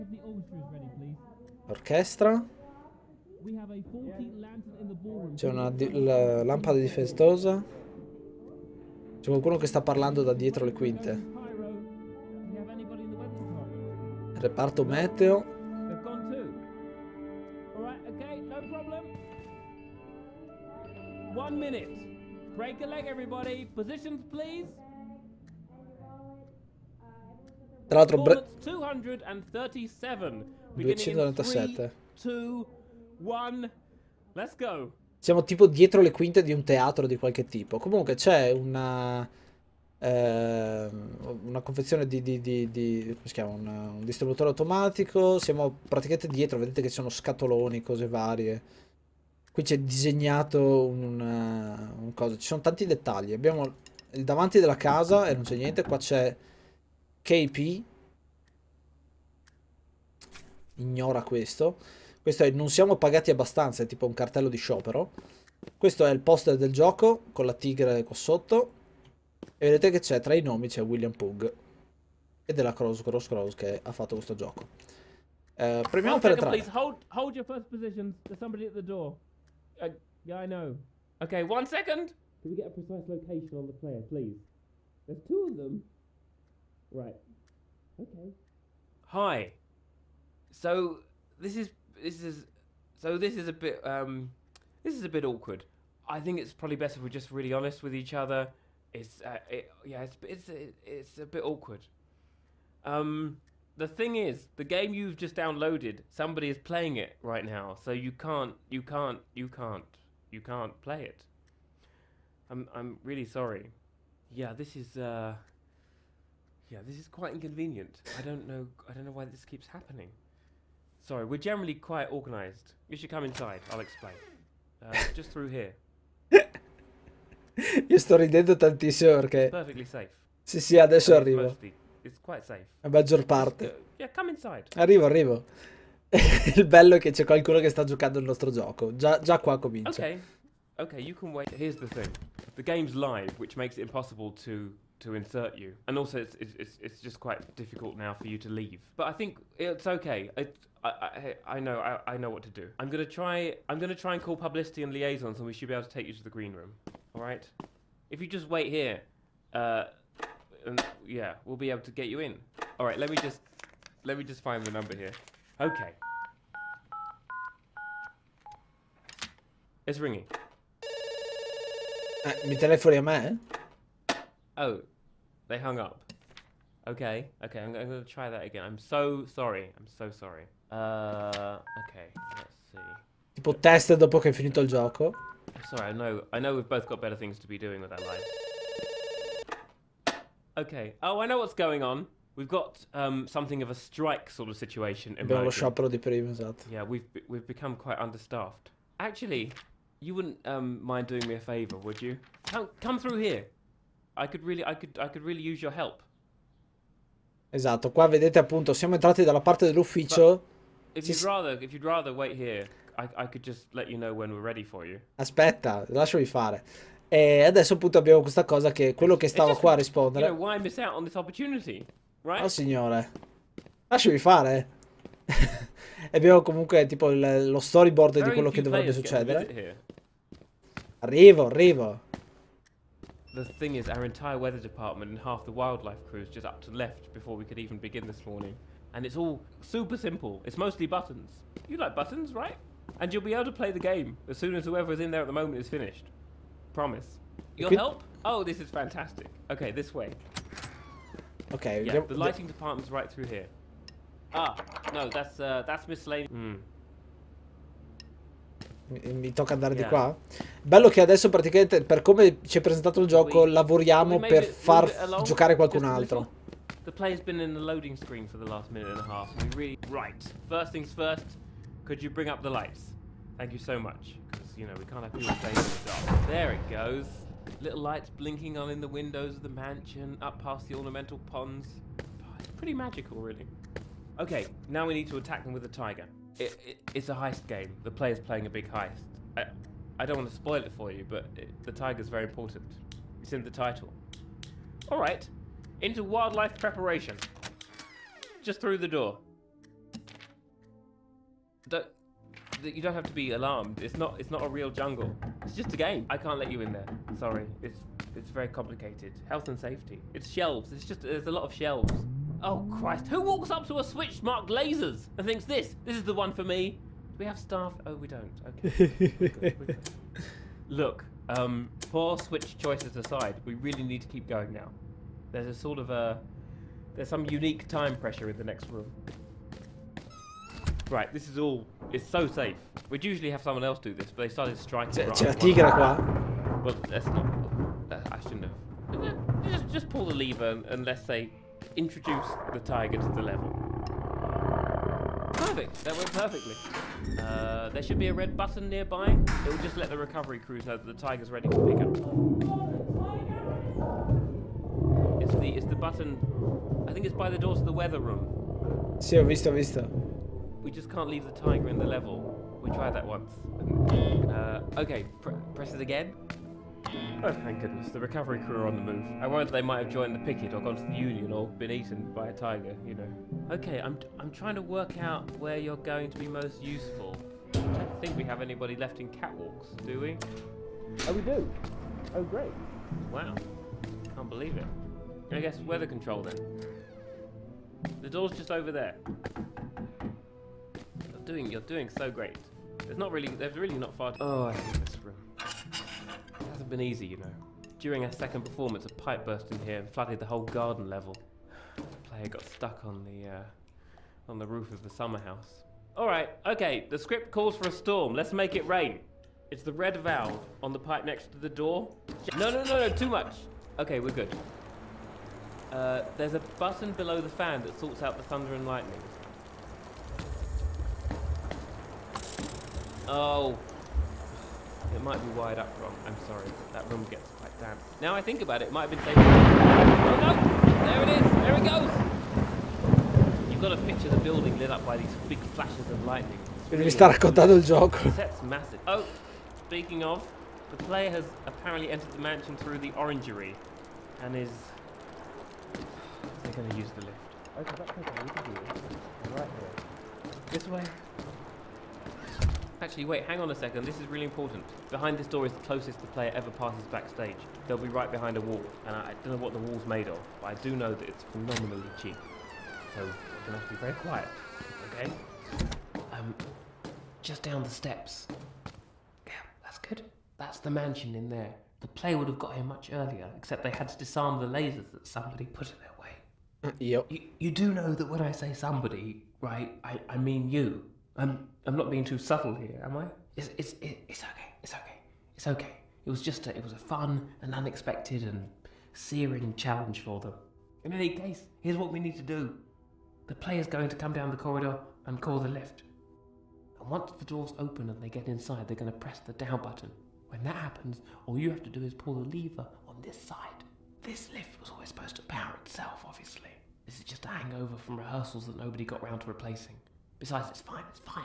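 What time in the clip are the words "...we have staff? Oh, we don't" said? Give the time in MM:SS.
05:17.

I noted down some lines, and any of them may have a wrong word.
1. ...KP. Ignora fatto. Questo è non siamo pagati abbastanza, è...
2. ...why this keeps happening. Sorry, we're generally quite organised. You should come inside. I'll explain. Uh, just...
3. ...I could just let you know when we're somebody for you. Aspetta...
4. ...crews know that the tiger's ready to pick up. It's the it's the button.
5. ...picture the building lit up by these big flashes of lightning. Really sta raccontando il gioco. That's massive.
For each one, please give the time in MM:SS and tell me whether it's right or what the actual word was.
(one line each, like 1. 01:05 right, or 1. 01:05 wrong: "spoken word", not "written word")
1. 00:57 wrong: "questo", not "fatto"
2. 01:59 right
3. 03:33 wrong: "ready", not "somebody"
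4. 05:50 right
5. 07:13 right.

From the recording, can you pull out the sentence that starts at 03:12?
We've got um, something of a strike sort of situation.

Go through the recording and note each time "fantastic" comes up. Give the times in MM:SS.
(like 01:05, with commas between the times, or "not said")
04:08.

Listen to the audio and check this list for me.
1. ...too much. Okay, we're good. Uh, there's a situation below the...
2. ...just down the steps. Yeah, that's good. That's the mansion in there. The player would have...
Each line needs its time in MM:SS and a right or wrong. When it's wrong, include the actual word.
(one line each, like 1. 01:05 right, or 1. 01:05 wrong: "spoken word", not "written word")
1. 06:52 wrong: "button", not "situation"
2. 07:47 right.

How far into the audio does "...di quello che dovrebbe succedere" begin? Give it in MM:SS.
03:48.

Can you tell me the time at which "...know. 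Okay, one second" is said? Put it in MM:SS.
01:20.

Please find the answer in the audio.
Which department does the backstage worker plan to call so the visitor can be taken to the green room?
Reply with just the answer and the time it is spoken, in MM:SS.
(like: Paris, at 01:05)
publicity and liaisons, at 02:34.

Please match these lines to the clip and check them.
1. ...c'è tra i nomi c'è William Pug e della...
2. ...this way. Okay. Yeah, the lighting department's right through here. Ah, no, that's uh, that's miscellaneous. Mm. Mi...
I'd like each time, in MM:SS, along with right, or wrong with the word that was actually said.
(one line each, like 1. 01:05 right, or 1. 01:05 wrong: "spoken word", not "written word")
1. 01:09 right
2. 04:09 right.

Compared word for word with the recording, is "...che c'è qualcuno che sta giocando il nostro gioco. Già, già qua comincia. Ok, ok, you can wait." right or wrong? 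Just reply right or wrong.
right.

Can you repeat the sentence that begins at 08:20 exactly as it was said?
When that happens, all you have to do is pull the lever on this side.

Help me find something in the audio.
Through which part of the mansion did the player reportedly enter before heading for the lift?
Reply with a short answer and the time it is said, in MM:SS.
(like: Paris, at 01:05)
the orangery, at 07:22.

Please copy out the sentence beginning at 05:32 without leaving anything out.
We'd usually have someone else do this, but they started striking.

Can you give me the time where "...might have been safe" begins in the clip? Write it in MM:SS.
07:08.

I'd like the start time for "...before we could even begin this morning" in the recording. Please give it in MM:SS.
03:57.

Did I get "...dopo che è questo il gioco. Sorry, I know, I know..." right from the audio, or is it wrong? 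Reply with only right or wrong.
wrong.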